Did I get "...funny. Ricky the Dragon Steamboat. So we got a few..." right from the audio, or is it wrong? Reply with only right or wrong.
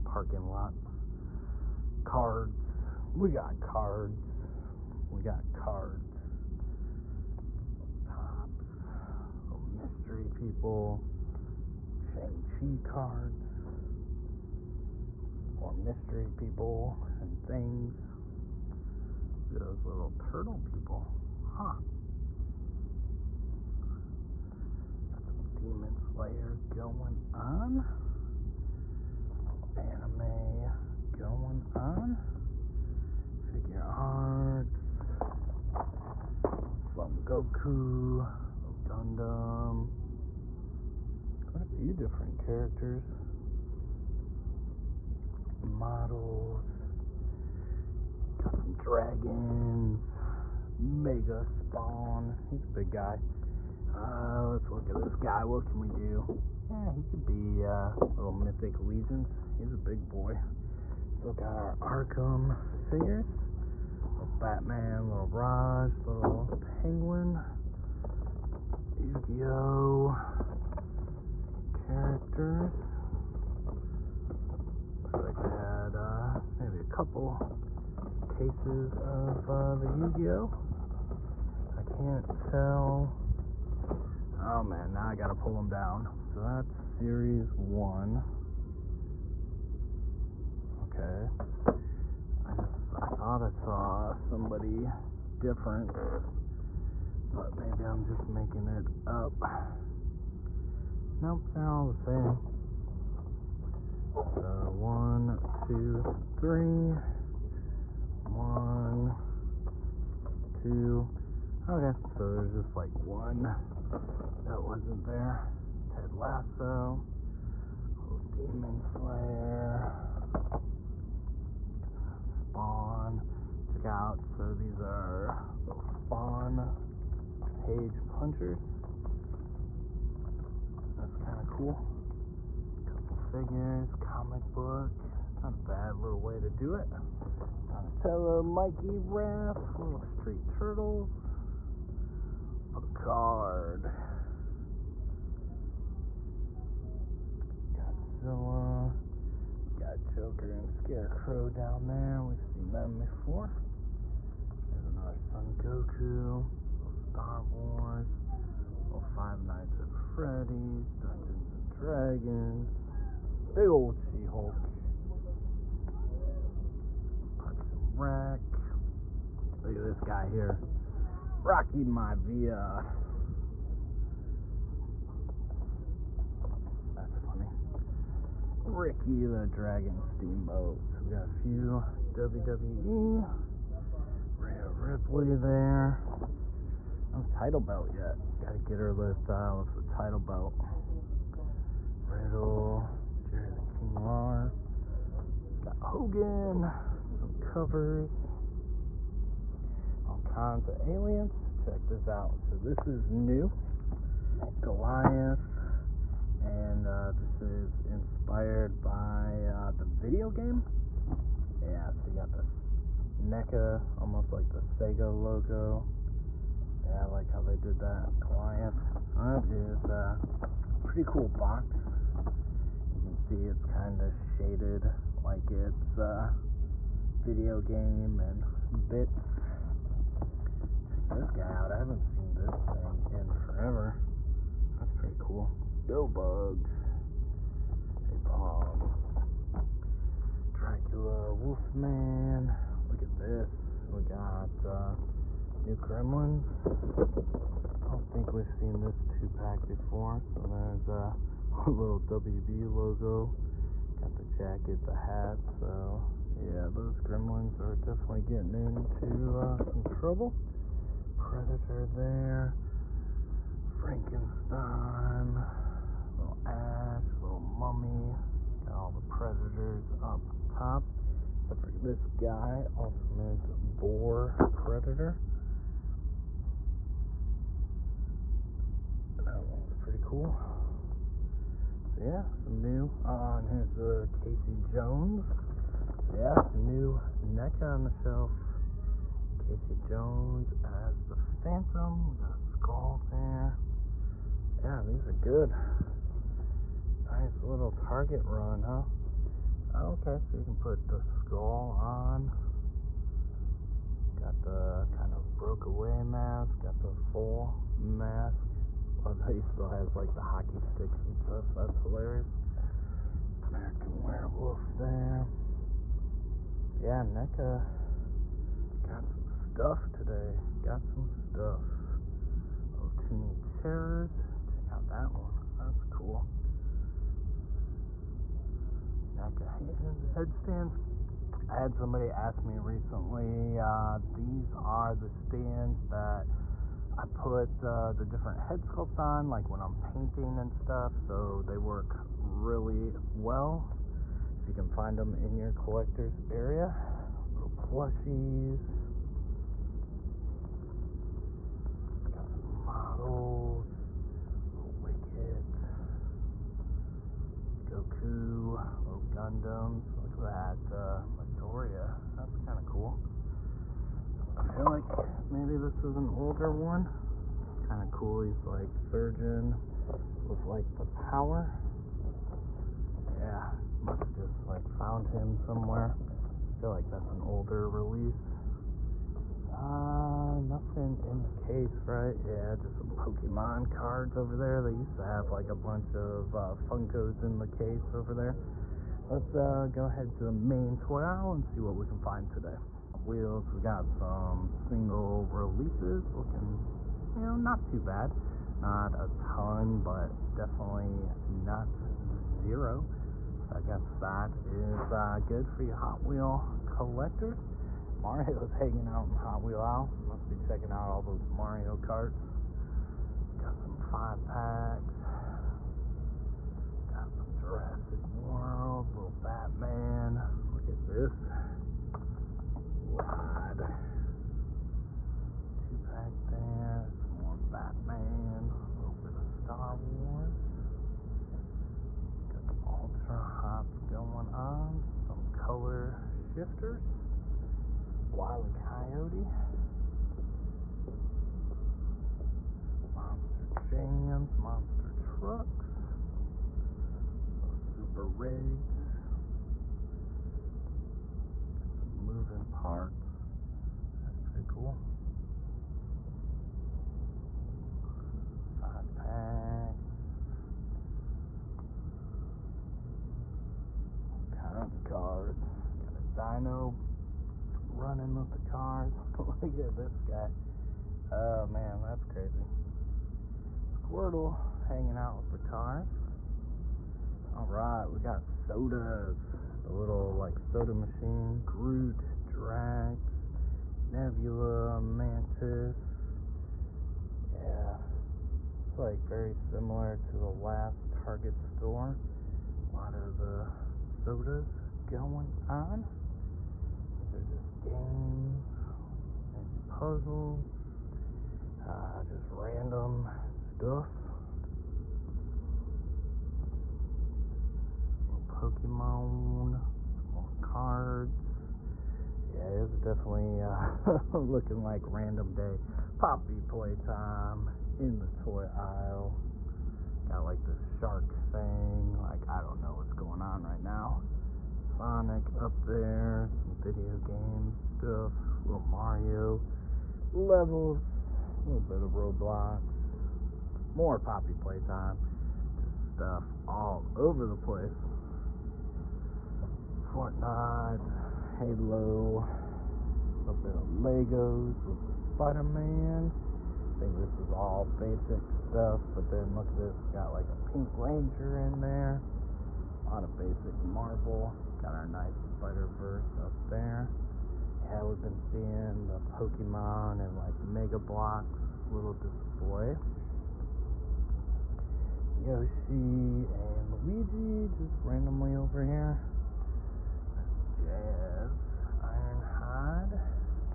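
right.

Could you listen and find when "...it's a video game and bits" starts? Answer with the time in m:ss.
3:45.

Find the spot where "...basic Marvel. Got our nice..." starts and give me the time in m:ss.
9:13.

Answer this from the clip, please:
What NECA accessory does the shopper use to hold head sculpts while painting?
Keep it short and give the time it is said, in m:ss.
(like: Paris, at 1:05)
NECA headstands, at 5:29.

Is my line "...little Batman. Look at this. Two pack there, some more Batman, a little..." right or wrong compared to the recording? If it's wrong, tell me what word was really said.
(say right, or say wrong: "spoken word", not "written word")
right.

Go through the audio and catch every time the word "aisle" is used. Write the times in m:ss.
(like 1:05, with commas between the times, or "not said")
6:31, 8:38.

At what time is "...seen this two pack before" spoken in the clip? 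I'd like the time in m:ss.
4:08.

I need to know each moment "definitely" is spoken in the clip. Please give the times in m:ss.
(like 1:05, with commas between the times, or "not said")
4:17, 6:40, 8:32.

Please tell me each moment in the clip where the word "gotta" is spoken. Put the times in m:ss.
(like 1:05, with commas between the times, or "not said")
1:25, 3:08.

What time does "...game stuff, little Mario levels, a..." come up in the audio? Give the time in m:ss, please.
8:46.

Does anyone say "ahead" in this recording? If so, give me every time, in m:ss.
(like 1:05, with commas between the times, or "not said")
6:29.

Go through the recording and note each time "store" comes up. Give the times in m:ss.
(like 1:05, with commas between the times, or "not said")
8:11.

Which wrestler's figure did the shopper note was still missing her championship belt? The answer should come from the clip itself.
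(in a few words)
Rhea Ripley.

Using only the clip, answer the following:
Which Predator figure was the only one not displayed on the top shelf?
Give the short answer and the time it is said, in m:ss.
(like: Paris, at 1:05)
Ultimate Boar Predator, at 4:32.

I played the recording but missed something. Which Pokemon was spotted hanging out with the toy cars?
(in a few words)
Squirtle.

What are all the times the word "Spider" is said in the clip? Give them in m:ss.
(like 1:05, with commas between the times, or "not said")
9:04, 9:15.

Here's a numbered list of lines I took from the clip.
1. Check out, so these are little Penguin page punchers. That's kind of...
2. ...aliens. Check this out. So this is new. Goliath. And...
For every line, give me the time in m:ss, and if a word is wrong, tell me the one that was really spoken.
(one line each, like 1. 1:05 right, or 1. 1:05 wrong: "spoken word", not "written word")
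1. 2:03 wrong: "Spawn", not "Penguin"
2. 3:20 right.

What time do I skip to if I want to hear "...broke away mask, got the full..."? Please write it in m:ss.
5:05.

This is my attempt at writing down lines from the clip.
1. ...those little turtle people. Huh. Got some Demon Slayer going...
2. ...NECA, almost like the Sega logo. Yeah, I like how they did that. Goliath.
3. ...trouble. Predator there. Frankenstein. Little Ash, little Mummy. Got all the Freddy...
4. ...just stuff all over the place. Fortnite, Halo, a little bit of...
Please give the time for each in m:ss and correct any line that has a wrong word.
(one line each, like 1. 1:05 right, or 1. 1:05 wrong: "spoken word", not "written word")
1. 0:19 right
2. 3:33 right
3. 4:19 wrong: "Predators", not "Freddy"
4. 8:55 right.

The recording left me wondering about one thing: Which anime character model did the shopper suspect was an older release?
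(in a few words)
Midoriya.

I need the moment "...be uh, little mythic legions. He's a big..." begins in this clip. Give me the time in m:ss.
0:57.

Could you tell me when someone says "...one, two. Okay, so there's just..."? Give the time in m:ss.
1:48.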